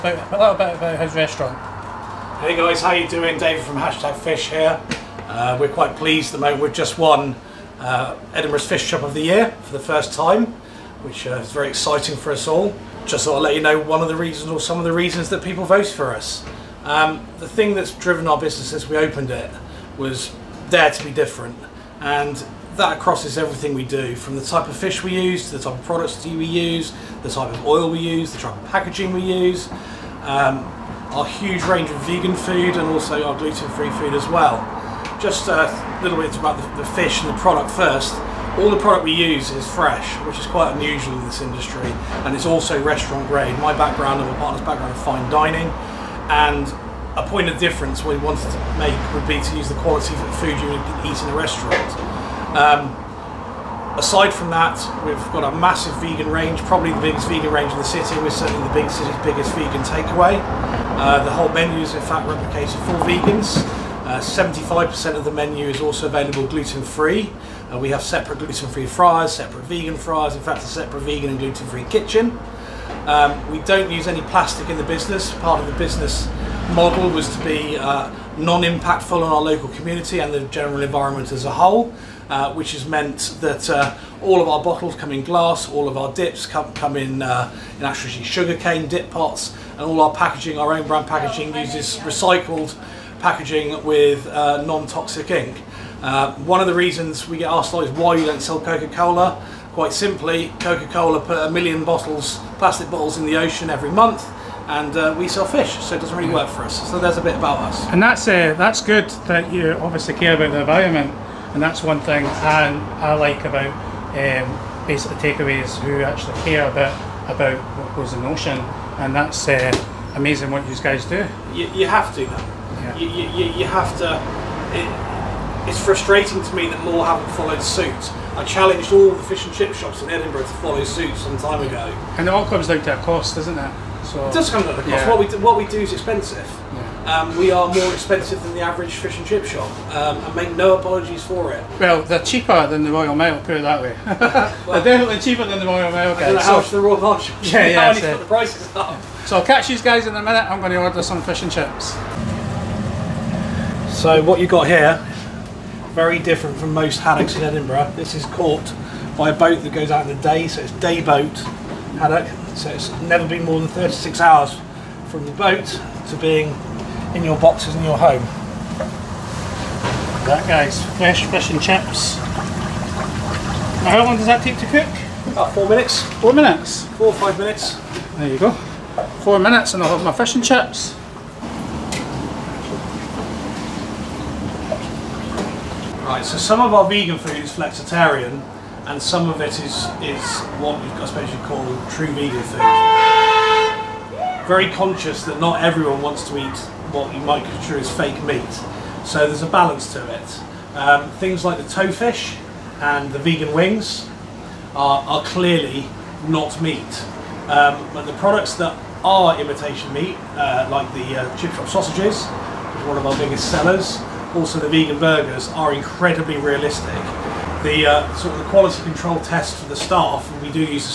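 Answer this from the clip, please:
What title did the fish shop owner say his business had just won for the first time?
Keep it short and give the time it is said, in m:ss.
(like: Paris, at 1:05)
Edinburgh's Fish Shop of the Year, at 0:08.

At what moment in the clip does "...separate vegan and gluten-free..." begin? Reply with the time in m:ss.
1:10.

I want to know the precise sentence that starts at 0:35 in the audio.
Just a little bit about the, the fish and the product first.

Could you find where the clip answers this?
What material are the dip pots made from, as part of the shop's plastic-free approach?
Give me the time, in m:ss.
1:28.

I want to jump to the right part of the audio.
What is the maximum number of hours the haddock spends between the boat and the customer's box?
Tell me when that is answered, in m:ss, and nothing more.
2:43.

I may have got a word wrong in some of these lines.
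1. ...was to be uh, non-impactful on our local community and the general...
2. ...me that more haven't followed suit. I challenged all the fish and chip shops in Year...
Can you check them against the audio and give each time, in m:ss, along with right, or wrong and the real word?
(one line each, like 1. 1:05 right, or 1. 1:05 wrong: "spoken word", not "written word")
1. 1:17 right
2. 2:06 wrong: "Edinburgh", not "Year".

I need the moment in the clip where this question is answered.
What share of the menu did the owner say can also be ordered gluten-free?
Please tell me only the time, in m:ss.
1:04.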